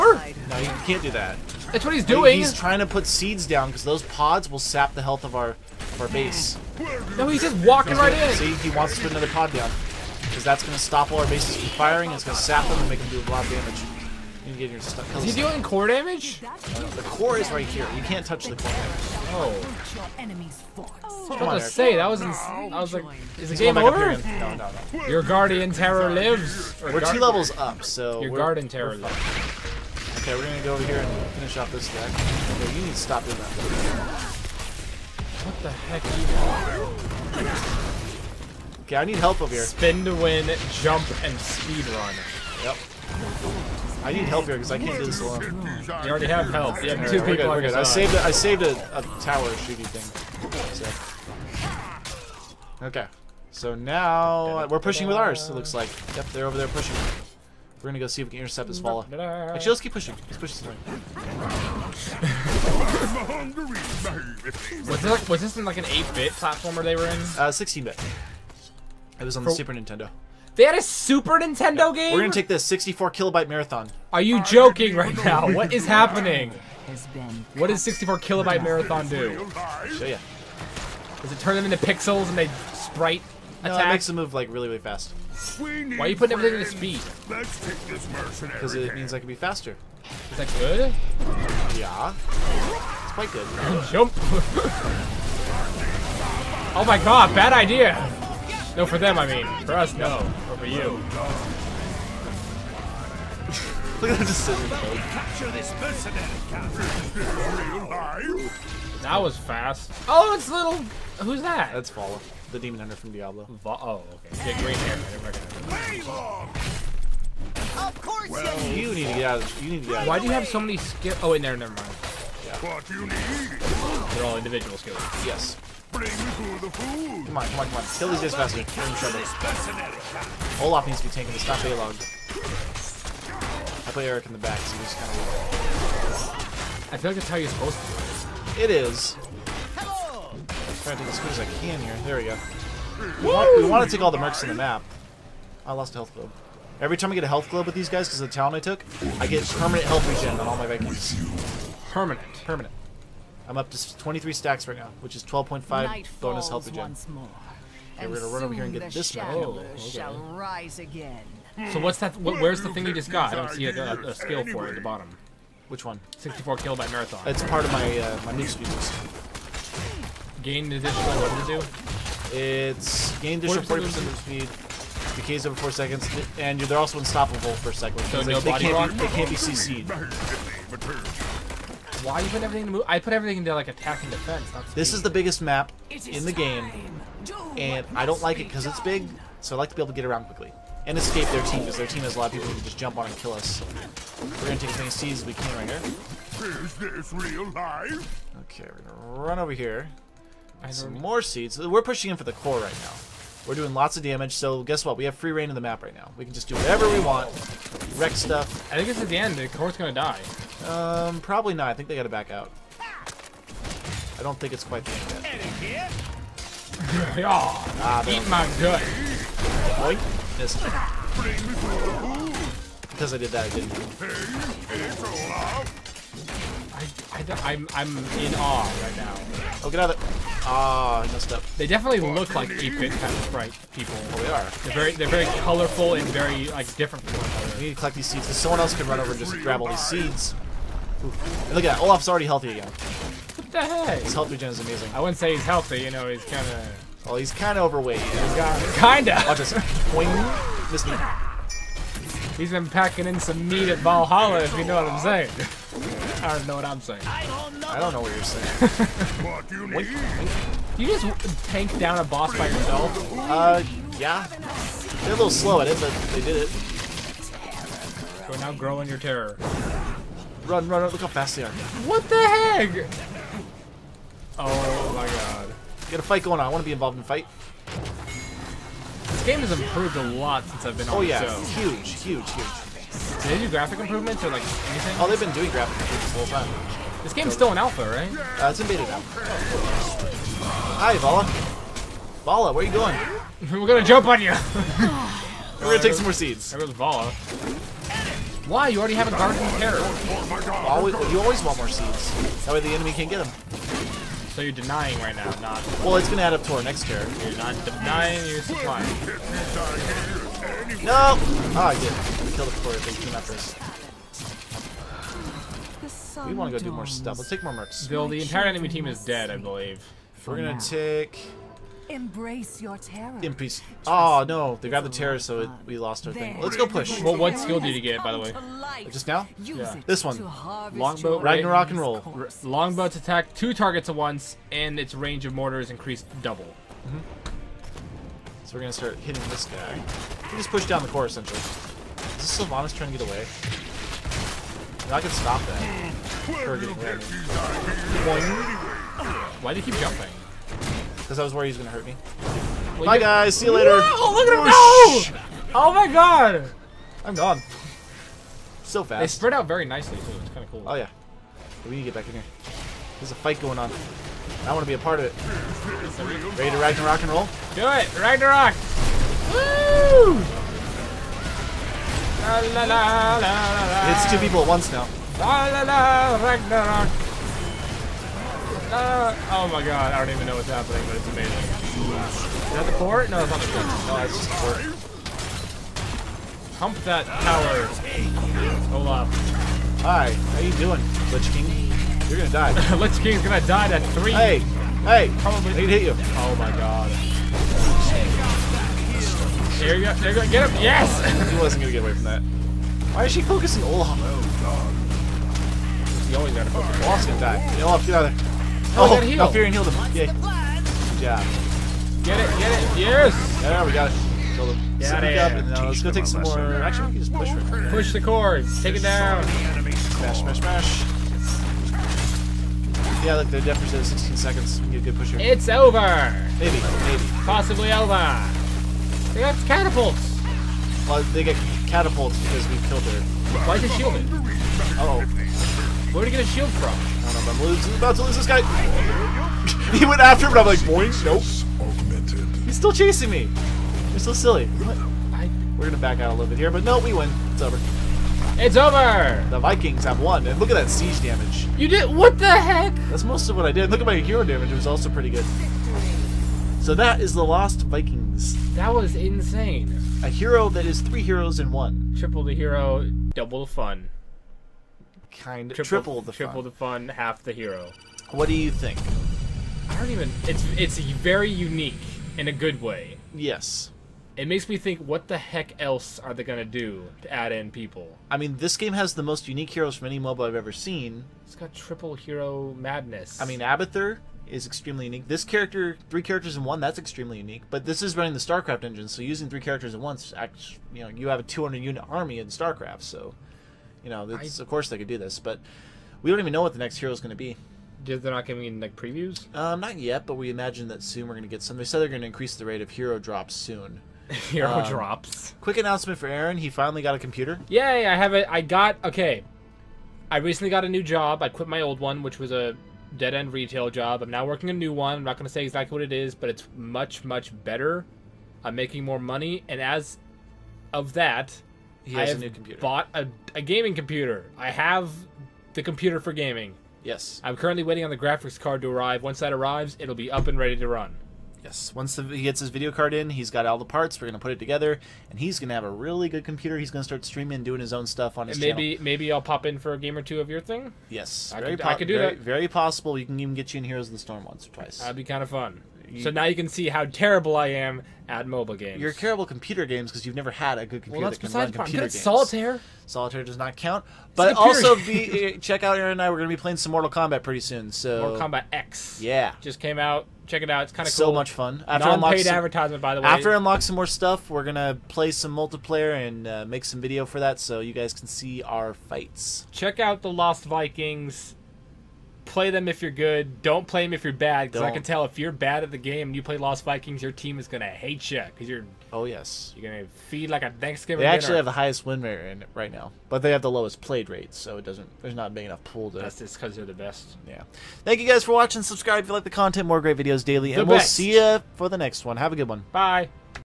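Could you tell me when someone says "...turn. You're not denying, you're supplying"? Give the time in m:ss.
5:06.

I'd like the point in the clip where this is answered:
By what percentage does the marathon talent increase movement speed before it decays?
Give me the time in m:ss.
2:53.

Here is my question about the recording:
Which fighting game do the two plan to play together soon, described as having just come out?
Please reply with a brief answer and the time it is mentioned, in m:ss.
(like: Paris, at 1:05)
Mortal Kombat X, at 9:18.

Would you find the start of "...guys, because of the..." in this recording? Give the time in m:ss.
2:27.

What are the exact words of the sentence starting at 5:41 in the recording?
Is this Sylvanas trying to get away?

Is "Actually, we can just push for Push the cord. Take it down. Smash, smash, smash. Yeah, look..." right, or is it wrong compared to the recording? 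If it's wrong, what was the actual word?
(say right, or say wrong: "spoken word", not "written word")
right.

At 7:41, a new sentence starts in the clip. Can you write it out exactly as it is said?
Triple the hero, double the fun kind of triple, triple the triple fun.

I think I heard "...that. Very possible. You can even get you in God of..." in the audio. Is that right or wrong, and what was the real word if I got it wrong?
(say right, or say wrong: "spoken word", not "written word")
wrong: "Heroes", not "God".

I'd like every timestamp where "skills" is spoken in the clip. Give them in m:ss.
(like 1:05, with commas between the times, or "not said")
2:00, 2:04, 2:44, 5:27.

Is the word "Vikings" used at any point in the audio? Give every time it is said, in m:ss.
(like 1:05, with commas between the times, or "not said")
2:30, 7:29, 7:37, 9:30, 9:36.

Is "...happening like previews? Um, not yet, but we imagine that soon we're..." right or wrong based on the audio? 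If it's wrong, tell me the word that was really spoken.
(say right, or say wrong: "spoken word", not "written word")
wrong: "giving", not "happening".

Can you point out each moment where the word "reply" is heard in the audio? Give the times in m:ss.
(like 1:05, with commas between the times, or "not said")
not said.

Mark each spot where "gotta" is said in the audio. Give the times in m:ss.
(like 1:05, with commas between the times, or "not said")
3:31, 6:46.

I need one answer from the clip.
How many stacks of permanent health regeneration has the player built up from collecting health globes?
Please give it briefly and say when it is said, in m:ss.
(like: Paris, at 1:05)
23, at 2:33.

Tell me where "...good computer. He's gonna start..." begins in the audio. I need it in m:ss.
8:56.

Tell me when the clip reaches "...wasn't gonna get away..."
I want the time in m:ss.
6:41.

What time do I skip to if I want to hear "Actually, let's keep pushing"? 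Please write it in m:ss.
0:59.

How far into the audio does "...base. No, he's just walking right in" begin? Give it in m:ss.
0:06.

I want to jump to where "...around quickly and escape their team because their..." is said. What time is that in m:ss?
3:10.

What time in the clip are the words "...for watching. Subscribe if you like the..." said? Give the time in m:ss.
9:48.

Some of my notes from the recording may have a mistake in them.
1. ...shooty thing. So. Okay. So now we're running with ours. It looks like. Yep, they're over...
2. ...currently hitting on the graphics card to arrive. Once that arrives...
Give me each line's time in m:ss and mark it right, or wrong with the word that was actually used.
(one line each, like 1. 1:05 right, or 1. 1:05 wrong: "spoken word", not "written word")
1. 0:49 wrong: "pushing", not "running"
2. 8:47 wrong: "waiting", not "hitting".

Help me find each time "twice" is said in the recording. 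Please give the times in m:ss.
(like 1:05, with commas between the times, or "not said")
9:04.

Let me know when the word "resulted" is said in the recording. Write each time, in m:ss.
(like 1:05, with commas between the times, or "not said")
not said.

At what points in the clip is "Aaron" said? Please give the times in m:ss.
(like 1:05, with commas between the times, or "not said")
8:26, 9:15.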